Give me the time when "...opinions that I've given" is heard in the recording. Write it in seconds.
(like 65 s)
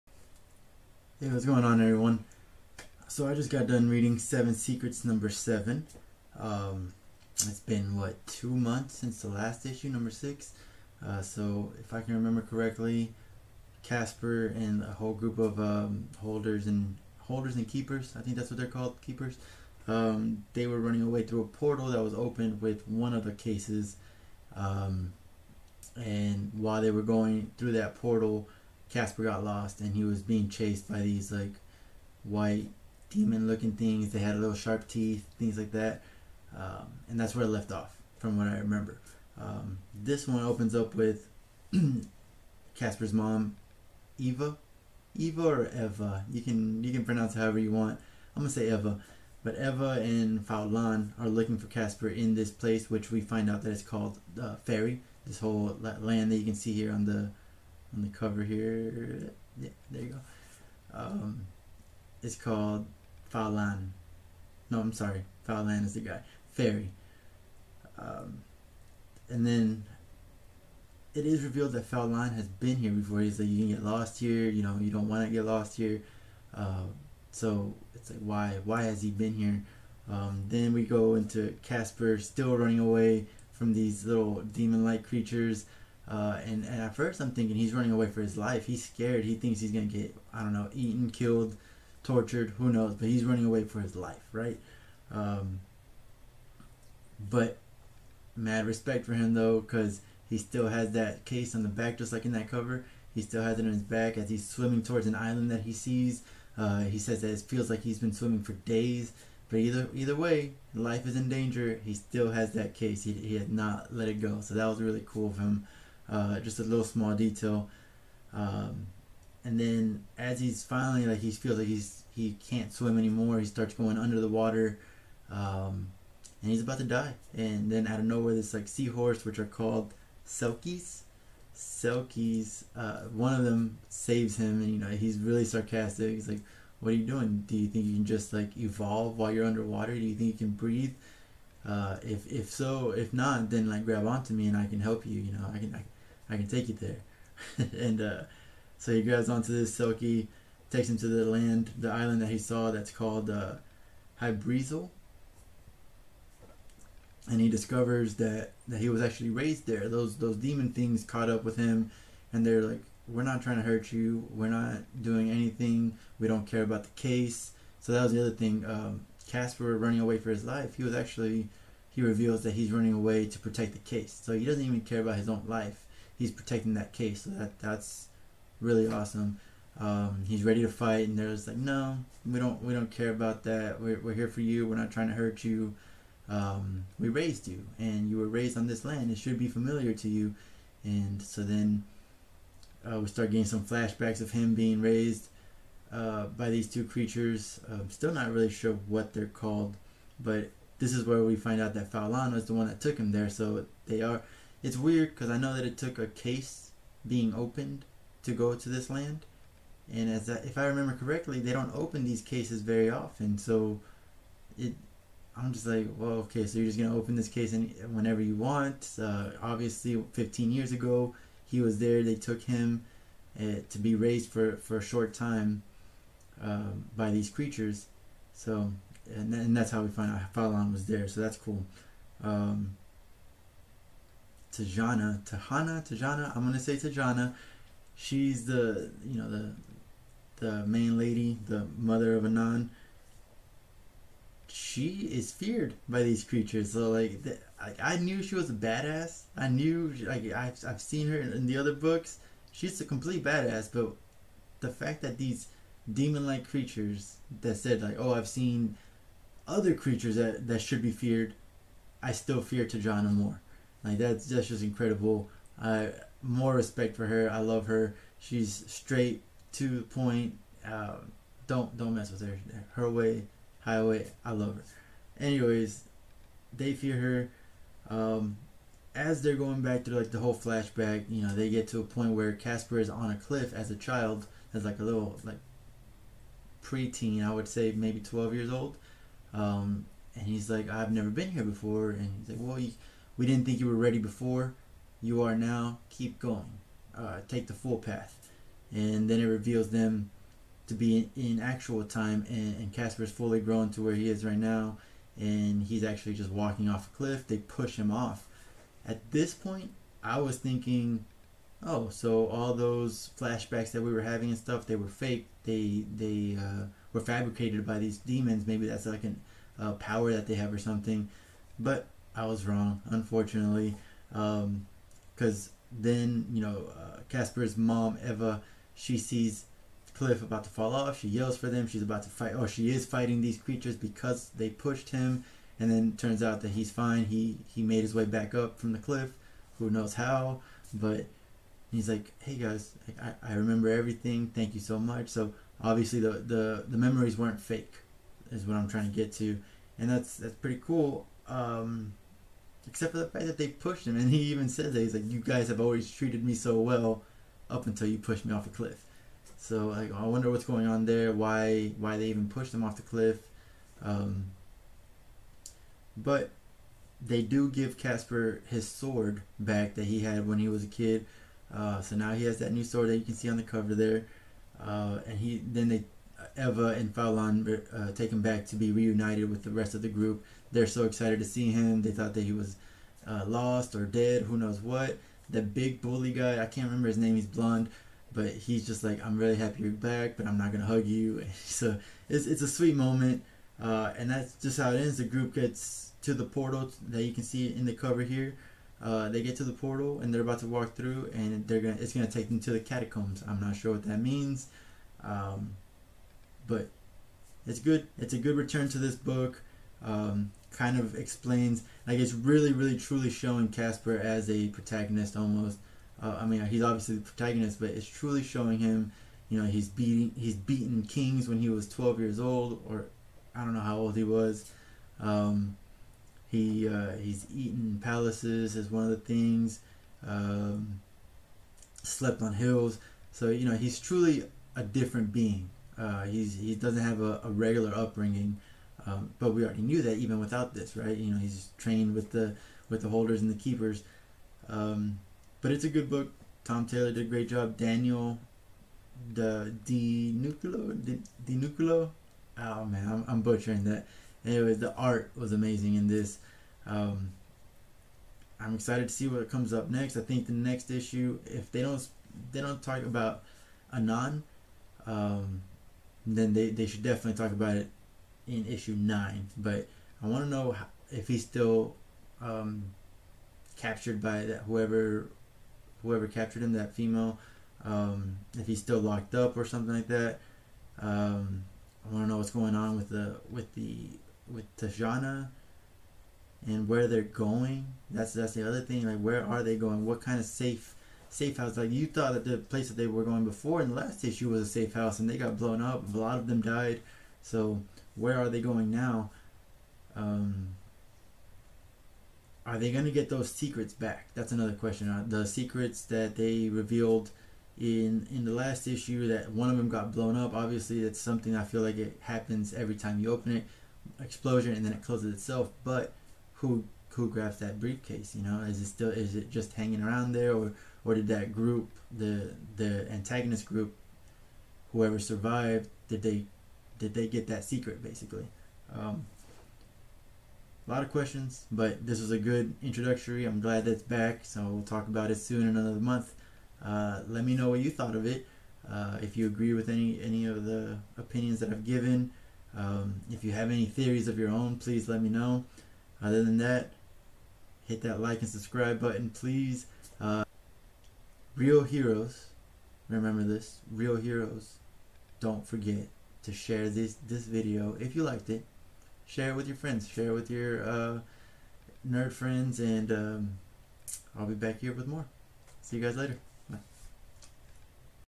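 540 s.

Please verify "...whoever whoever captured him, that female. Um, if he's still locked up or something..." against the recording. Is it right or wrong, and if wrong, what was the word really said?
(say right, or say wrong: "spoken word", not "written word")
right.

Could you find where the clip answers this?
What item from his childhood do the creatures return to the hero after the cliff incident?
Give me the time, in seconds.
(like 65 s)
368 s.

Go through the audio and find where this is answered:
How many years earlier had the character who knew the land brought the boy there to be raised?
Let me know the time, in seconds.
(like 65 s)
220 s.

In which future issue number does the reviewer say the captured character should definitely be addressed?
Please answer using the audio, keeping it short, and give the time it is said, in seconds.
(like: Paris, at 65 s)
9, at 468 s.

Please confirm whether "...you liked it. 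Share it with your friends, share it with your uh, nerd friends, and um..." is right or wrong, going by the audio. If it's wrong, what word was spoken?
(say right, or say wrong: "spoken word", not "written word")
right.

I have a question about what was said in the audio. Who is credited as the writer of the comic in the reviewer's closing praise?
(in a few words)
Tom Taylor.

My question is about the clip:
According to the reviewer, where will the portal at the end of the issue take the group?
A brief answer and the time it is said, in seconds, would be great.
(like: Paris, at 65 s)
The catacombs, at 402 s.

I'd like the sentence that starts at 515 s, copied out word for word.
But who who grabs that briefcase?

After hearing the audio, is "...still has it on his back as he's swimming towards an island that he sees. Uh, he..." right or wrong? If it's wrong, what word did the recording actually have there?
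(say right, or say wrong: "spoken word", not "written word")
right.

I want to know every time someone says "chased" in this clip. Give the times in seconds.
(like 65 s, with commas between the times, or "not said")
30 s.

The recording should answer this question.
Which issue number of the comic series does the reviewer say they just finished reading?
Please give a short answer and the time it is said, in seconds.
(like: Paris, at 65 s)
7, at 5 s.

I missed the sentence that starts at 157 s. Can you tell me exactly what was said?
And he discovers that, that he was actually raised there.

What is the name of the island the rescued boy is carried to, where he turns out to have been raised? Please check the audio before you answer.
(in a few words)
Hybrizel.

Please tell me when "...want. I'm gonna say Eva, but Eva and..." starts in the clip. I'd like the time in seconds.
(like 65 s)
47 s.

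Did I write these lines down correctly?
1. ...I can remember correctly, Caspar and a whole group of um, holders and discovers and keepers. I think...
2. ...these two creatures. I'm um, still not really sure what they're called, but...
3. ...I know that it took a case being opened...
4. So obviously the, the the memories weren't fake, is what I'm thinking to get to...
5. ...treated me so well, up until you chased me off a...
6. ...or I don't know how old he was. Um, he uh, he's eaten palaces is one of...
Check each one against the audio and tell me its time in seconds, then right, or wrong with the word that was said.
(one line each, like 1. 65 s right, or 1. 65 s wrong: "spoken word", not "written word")
1. 11 s wrong: "holders", not "discovers"
2. 196 s right
3. 205 s right
4. 345 s wrong: "trying", not "thinking"
5. 355 s wrong: "pushed", not "chased"
6. 422 s right.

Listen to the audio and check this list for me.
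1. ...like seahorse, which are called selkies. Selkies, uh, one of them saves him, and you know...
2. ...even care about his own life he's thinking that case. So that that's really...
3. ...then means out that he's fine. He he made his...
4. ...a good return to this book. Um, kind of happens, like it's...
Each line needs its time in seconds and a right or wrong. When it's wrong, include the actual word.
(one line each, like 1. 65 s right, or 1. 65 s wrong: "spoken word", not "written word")
1. 128 s right
2. 174 s wrong: "protecting", not "thinking"
3. 335 s wrong: "turns", not "means"
4. 408 s wrong: "explains", not "happens".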